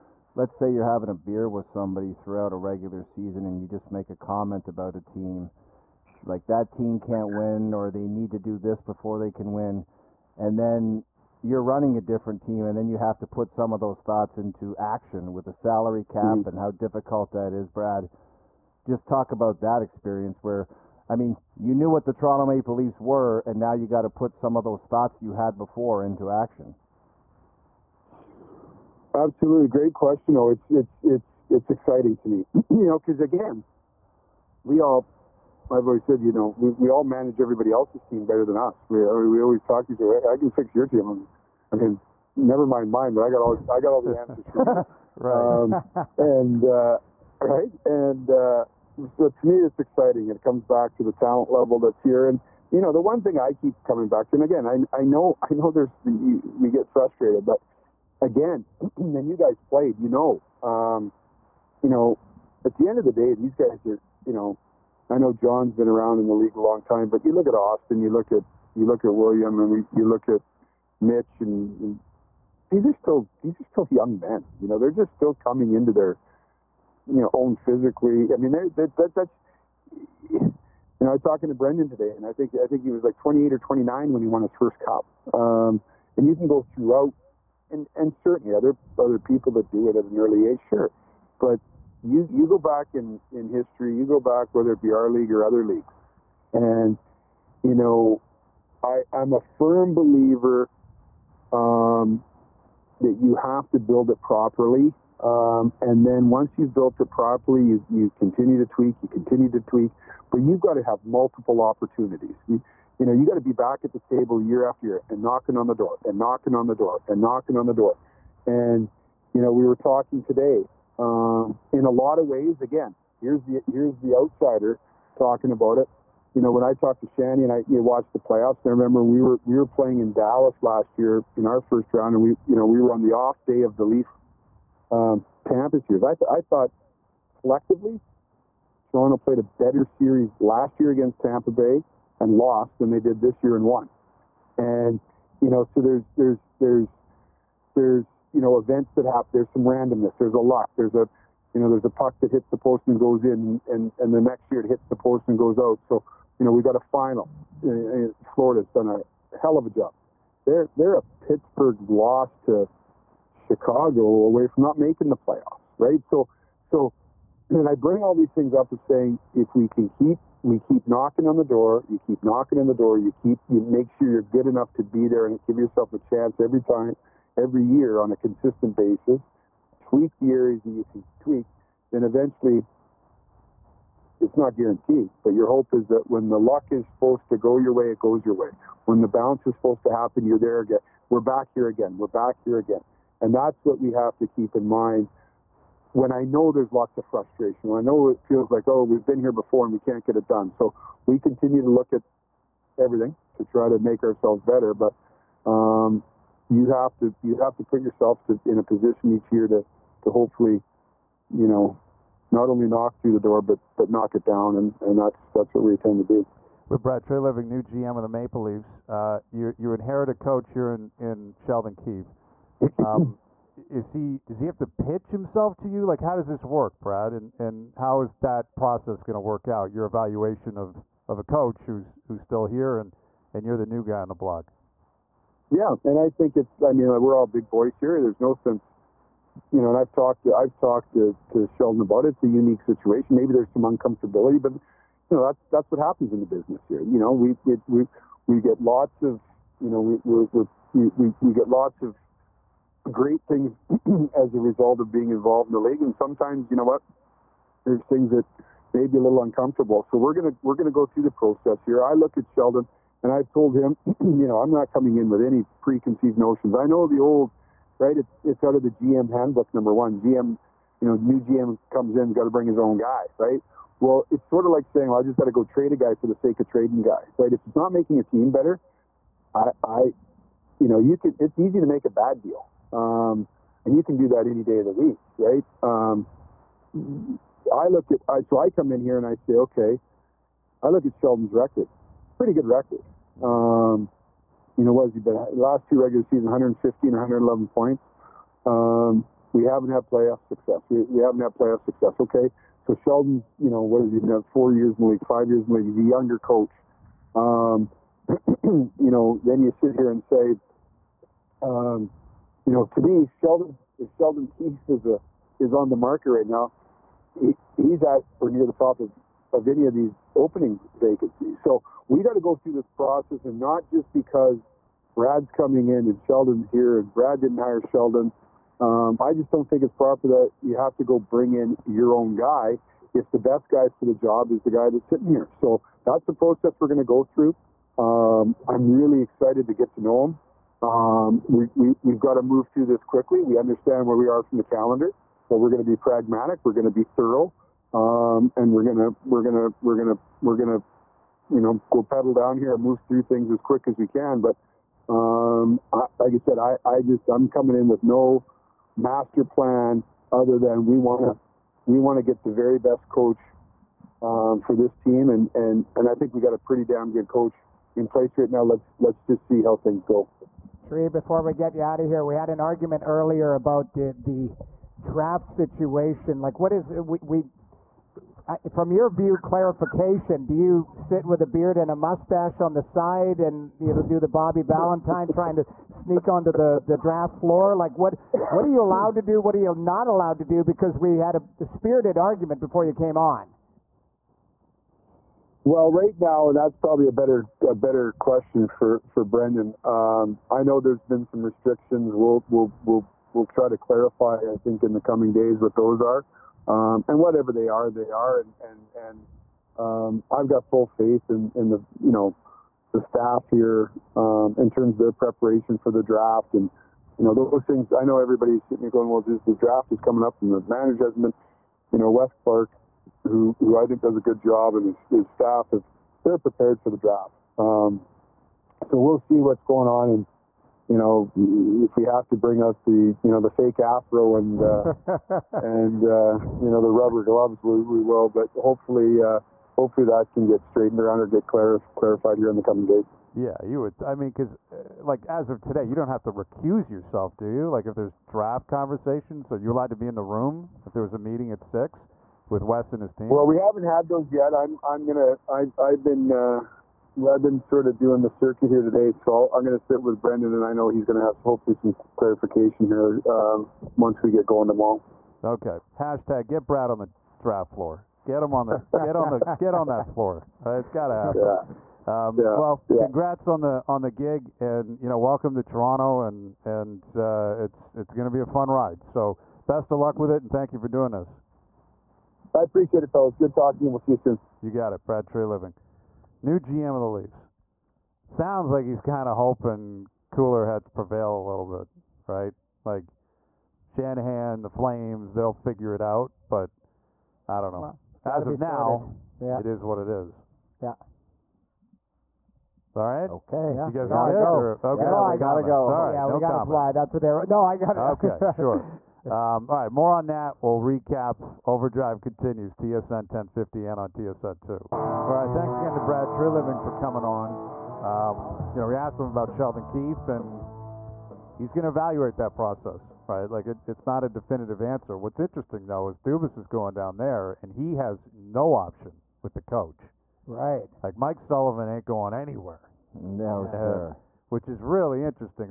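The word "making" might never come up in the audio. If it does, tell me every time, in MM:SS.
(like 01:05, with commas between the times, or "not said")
02:44, 04:37.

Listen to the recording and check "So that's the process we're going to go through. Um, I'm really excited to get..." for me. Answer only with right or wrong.
right.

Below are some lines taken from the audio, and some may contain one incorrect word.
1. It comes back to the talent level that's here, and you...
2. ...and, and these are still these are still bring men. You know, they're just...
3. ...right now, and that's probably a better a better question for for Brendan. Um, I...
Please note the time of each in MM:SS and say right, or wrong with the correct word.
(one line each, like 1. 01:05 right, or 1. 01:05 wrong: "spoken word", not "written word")
1. 00:50 right
2. 01:11 wrong: "young", not "bring"
3. 06:35 right.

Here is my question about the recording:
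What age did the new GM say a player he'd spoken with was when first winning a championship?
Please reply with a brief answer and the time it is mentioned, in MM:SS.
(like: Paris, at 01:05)
28 or 29, at 01:23.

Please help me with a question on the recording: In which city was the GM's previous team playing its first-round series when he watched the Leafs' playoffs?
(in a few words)
Dallas.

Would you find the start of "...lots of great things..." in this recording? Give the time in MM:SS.
04:11.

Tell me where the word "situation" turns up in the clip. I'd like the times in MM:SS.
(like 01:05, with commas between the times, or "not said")
04:02, 06:15.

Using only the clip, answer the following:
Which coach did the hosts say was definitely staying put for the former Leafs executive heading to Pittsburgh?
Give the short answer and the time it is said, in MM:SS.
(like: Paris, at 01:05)
Mike Sullivan, at 08:50.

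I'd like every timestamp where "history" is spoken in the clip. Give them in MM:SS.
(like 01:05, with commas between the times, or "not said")
01:33.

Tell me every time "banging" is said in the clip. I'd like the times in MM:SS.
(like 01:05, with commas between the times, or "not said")
not said.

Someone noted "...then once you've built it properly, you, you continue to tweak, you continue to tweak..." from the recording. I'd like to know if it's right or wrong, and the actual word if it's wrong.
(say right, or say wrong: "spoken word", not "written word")
right.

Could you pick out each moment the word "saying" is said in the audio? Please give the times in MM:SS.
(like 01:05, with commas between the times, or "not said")
02:48, 04:34.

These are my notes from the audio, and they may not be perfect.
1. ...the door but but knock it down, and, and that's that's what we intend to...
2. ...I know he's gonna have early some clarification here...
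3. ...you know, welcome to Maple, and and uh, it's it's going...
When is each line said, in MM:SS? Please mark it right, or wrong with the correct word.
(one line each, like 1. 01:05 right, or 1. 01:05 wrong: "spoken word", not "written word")
1. 03:33 right
2. 07:40 wrong: "hopefully", not "early"
3. 07:54 wrong: "Toronto", not "Maple".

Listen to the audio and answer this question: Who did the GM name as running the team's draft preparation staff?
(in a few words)
Wes Clark.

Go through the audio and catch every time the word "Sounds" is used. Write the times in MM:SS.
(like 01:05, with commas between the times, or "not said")
08:08.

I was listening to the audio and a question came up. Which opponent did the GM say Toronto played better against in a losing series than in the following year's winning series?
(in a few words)
Tampa Bay.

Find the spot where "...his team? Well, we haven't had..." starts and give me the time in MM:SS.
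07:32.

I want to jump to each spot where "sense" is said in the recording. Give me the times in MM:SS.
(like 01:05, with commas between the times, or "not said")
03:58.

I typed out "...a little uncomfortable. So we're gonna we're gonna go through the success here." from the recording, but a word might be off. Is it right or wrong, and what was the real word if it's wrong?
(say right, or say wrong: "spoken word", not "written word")
wrong: "process", not "success".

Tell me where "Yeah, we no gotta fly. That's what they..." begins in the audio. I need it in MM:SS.
08:25.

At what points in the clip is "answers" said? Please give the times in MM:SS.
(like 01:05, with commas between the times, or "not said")
00:44, 08:44.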